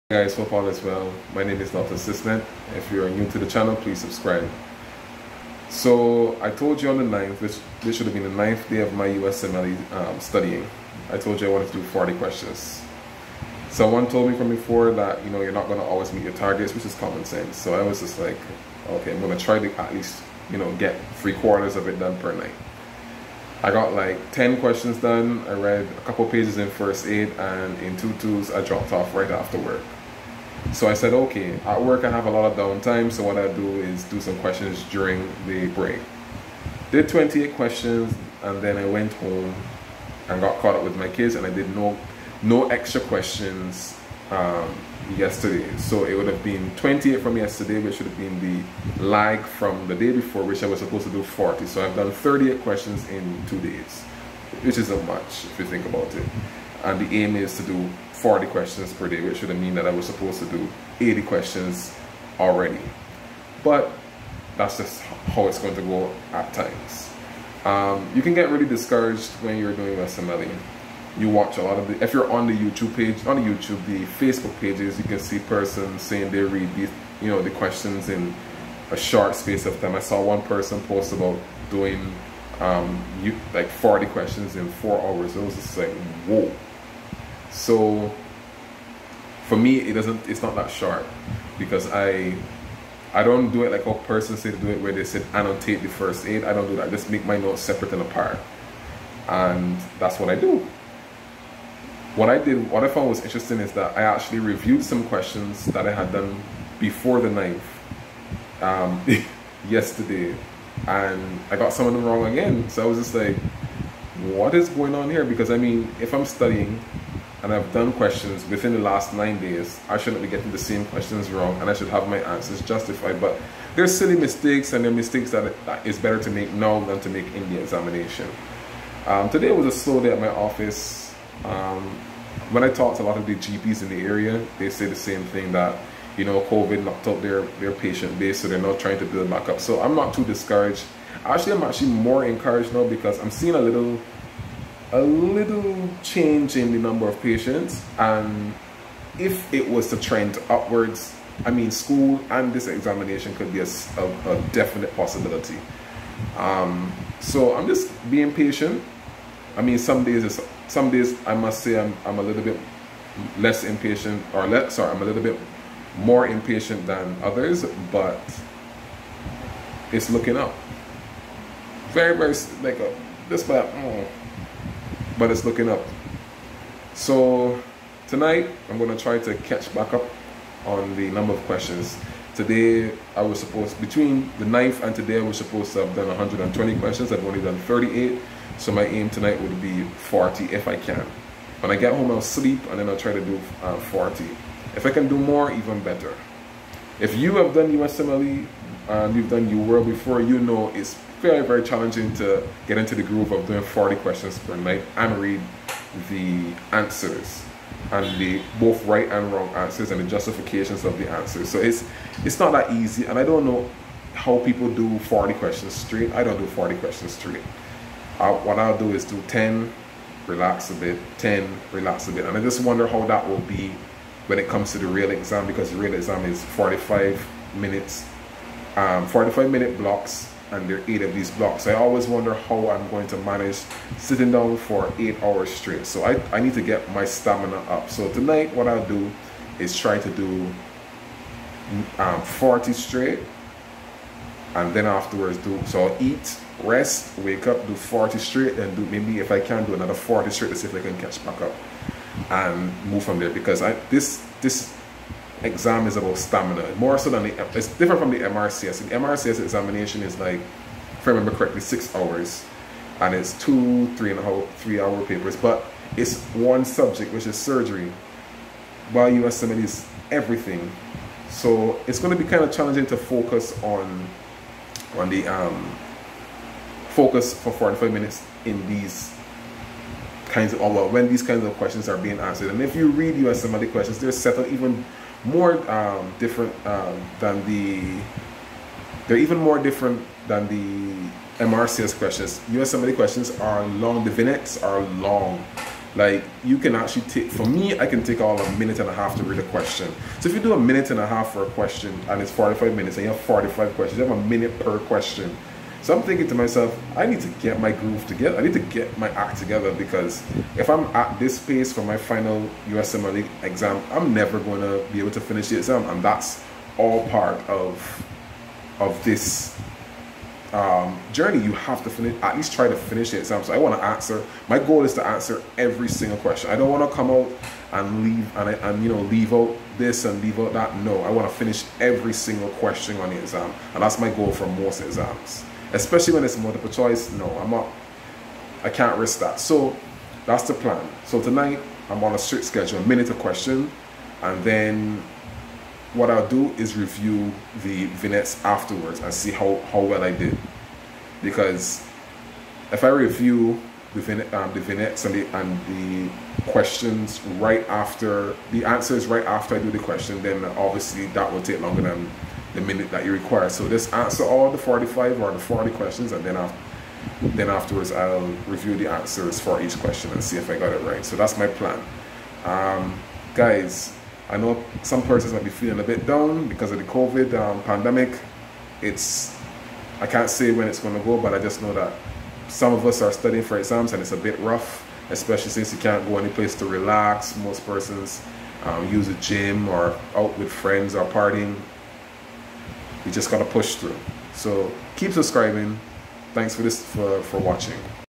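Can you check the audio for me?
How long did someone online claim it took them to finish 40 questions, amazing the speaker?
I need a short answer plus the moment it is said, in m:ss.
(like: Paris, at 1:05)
4 hours, at 1:24.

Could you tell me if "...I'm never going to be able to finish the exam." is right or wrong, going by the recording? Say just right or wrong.
right.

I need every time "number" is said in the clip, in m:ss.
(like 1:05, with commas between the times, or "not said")
2:26, 3:01.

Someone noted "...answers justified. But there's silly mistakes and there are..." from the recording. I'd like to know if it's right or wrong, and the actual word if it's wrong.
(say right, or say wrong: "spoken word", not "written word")
right.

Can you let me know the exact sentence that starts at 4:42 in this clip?
And if you read the questions, they're set up even more um, different um, than the.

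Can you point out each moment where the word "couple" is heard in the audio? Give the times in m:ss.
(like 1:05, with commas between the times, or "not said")
0:26.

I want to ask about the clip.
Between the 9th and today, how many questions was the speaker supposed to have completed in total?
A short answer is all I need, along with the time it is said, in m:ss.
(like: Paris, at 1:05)
120, at 3:06.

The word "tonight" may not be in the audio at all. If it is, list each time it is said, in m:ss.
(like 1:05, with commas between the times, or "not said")
2:58, 3:09, 3:58, 5:41.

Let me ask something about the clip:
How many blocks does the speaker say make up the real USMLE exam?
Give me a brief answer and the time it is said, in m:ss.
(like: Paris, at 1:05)
8, at 3:50.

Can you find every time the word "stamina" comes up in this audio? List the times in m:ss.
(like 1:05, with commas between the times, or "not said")
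3:57, 4:16.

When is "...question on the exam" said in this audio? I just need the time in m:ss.
5:32.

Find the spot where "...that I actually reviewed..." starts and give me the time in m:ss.
1:43.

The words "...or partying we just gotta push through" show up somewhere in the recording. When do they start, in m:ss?
6:30.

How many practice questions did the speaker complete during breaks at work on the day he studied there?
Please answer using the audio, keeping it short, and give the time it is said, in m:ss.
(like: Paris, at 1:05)
28, at 0:36.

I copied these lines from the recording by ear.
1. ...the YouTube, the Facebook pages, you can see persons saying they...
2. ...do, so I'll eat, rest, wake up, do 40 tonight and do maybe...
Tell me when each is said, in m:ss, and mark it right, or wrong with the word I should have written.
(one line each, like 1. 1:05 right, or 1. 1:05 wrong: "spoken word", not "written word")
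1. 1:13 right
2. 4:05 wrong: "straight", not "tonight".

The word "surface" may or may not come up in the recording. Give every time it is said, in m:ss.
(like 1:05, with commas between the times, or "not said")
not said.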